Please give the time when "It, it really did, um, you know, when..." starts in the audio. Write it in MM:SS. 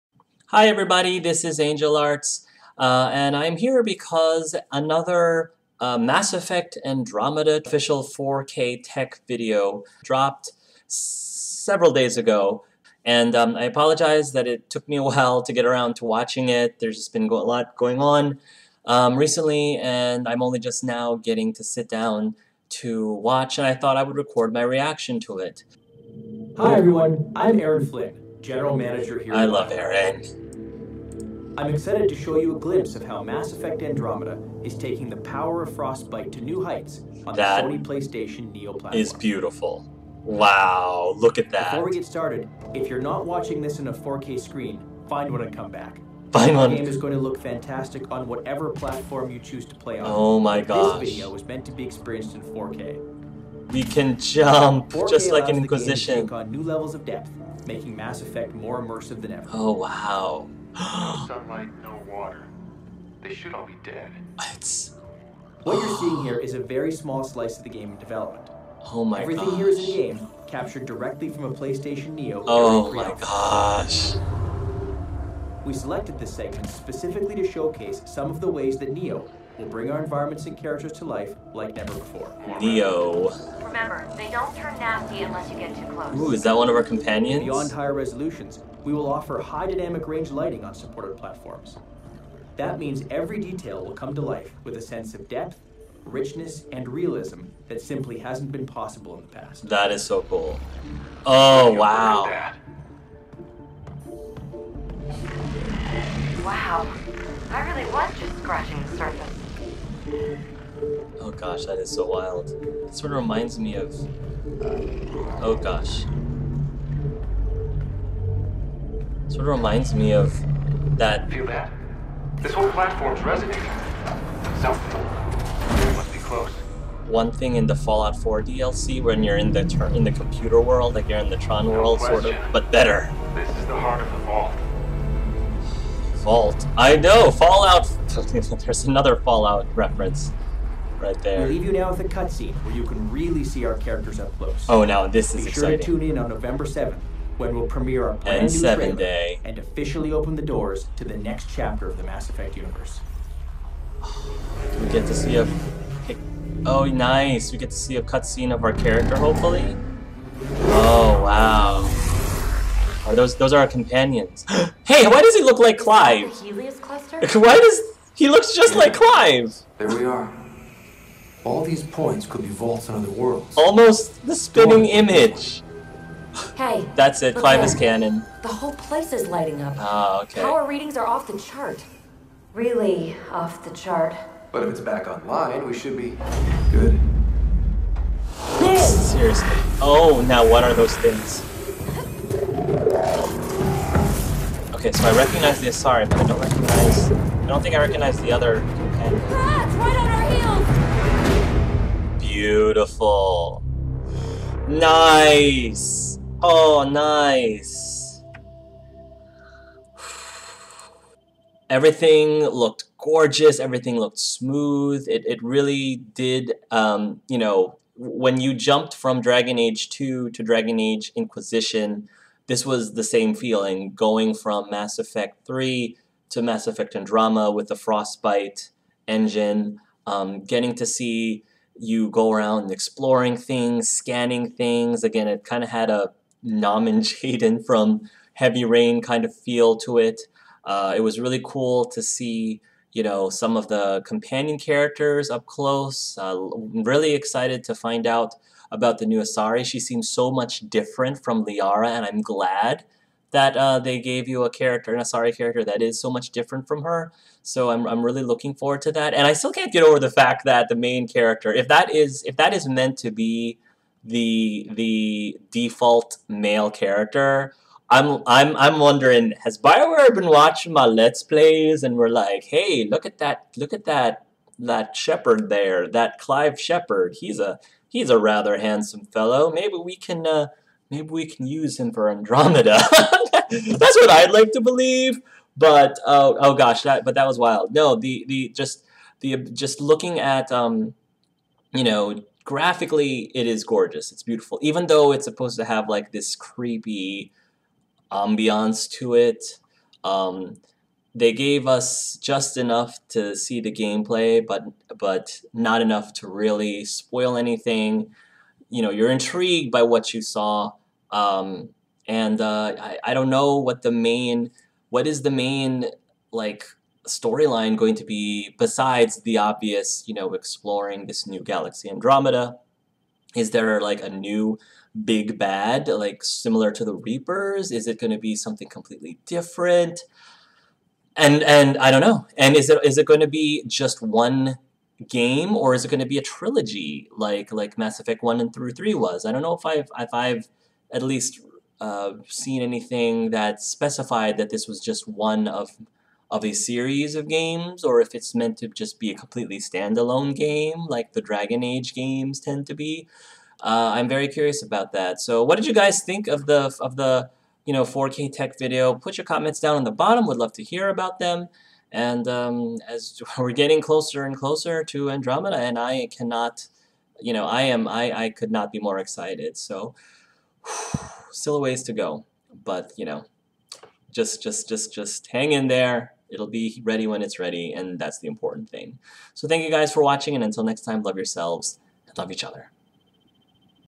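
03:35.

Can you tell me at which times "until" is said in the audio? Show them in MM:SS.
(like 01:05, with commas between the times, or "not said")
06:20.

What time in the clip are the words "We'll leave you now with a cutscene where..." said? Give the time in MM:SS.
02:21.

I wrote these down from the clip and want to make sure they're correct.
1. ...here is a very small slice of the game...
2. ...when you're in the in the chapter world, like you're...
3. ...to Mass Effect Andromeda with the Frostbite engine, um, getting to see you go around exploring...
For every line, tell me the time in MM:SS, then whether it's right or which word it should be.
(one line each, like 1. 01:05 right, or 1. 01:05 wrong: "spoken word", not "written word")
1. 01:06 right
2. 02:09 wrong: "computer", not "chapter"
3. 03:46 right.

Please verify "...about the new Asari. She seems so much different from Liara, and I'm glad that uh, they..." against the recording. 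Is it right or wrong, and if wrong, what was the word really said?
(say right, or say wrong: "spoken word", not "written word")
right.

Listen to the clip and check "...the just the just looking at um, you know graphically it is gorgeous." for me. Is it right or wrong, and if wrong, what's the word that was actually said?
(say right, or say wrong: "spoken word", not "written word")
right.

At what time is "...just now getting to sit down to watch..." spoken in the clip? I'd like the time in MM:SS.
00:20.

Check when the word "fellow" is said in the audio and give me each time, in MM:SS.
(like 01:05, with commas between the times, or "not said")
04:39.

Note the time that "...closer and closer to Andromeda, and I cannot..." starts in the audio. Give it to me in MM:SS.
06:03.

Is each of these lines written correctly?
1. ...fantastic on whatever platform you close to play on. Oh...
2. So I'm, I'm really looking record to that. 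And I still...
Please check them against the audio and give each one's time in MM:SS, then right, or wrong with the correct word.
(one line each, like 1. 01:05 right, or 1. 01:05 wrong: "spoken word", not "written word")
1. 00:47 wrong: "choose", not "close"
2. 04:17 wrong: "forward", not "record".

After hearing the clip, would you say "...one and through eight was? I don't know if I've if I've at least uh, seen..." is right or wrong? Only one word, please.
wrong.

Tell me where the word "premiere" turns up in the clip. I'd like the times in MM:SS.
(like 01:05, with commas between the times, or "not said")
02:27.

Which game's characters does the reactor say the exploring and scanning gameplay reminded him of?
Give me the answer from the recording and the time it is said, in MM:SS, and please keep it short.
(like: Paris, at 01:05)
Heavy Rain, at 03:58.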